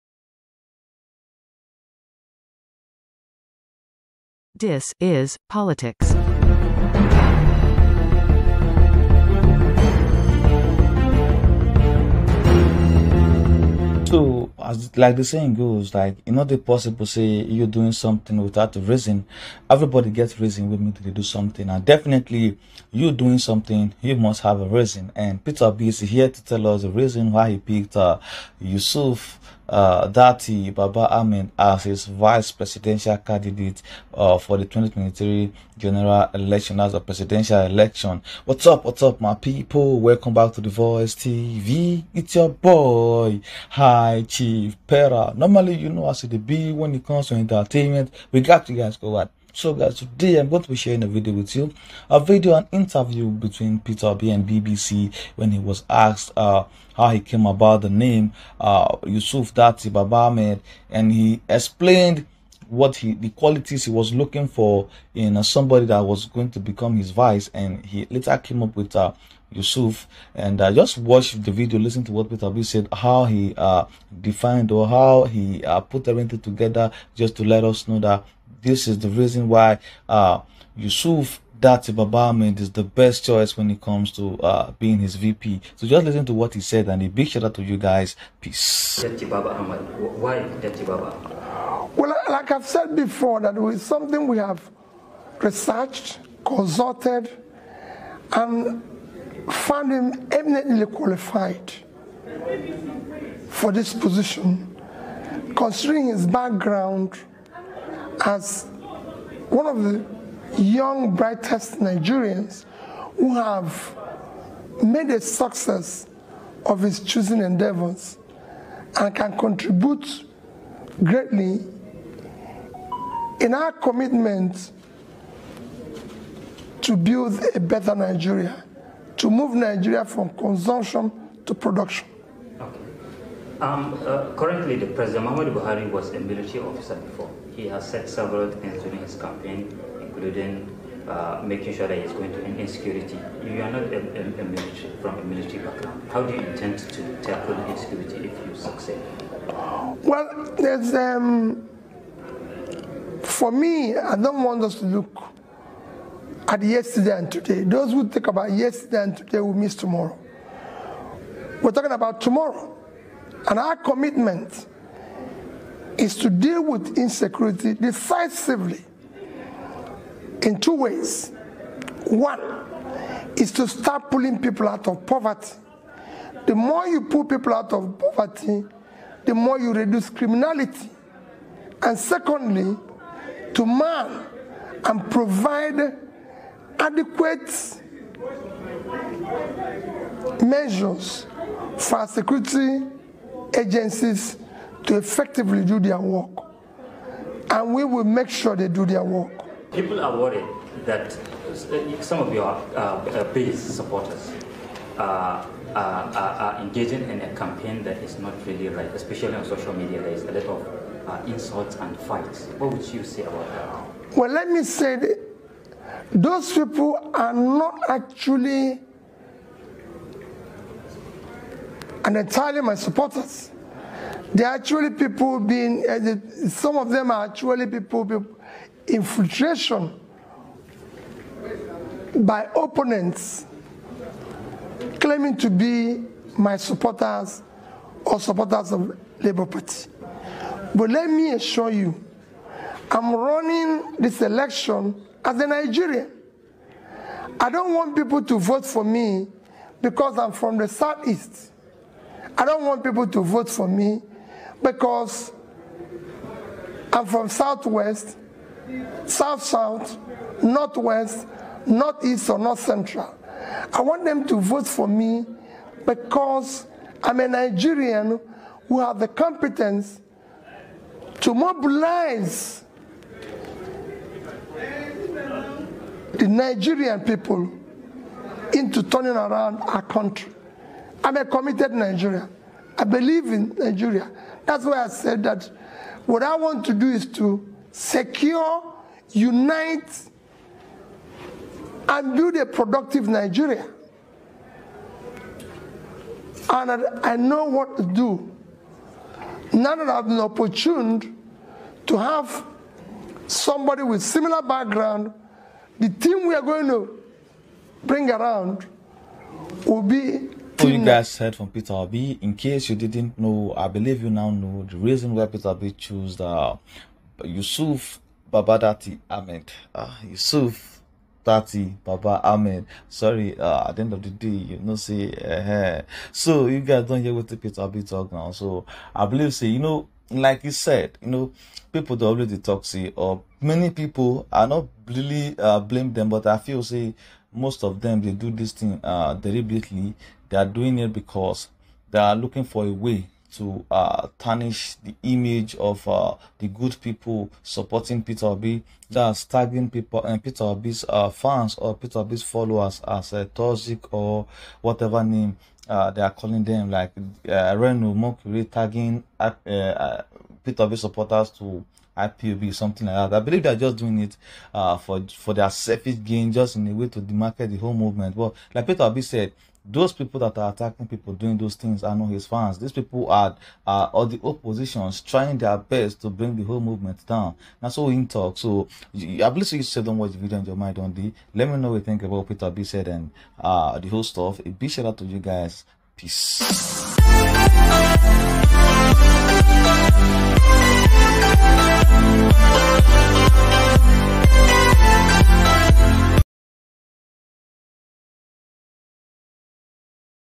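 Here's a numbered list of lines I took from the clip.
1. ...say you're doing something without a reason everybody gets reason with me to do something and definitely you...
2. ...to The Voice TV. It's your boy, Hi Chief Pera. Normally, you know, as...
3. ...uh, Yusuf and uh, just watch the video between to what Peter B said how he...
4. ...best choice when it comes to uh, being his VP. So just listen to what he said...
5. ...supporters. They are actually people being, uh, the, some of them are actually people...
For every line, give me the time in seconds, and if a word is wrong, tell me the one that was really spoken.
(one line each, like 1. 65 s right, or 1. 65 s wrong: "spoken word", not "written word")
1. 17 s right
2. 40 s right
3. 68 s wrong: "listen", not "between"
4. 82 s right
5. 222 s right.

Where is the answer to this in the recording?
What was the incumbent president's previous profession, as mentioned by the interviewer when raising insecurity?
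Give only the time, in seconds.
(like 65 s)
136 s.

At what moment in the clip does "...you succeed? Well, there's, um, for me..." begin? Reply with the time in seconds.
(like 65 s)
148 s.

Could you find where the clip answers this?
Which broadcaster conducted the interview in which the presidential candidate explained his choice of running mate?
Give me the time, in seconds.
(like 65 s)
54 s.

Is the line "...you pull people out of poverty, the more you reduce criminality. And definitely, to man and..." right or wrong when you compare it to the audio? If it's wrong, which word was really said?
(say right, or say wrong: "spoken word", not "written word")
wrong: "secondly", not "definitely".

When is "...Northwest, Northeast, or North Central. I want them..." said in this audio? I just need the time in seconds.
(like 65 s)
260 s.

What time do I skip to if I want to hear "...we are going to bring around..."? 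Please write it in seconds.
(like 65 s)
306 s.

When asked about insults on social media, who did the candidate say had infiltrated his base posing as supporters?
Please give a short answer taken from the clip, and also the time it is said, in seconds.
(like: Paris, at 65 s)
Opponents, at 232 s.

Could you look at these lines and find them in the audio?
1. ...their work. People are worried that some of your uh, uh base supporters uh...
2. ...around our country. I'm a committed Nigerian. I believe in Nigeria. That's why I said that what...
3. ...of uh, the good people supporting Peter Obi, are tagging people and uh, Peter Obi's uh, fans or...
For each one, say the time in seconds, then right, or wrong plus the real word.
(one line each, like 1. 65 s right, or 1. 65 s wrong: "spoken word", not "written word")
1. 198 s right
2. 279 s right
3. 345 s right.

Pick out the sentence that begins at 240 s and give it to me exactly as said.
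But let me assure you, I'm running this election as a Nigerian.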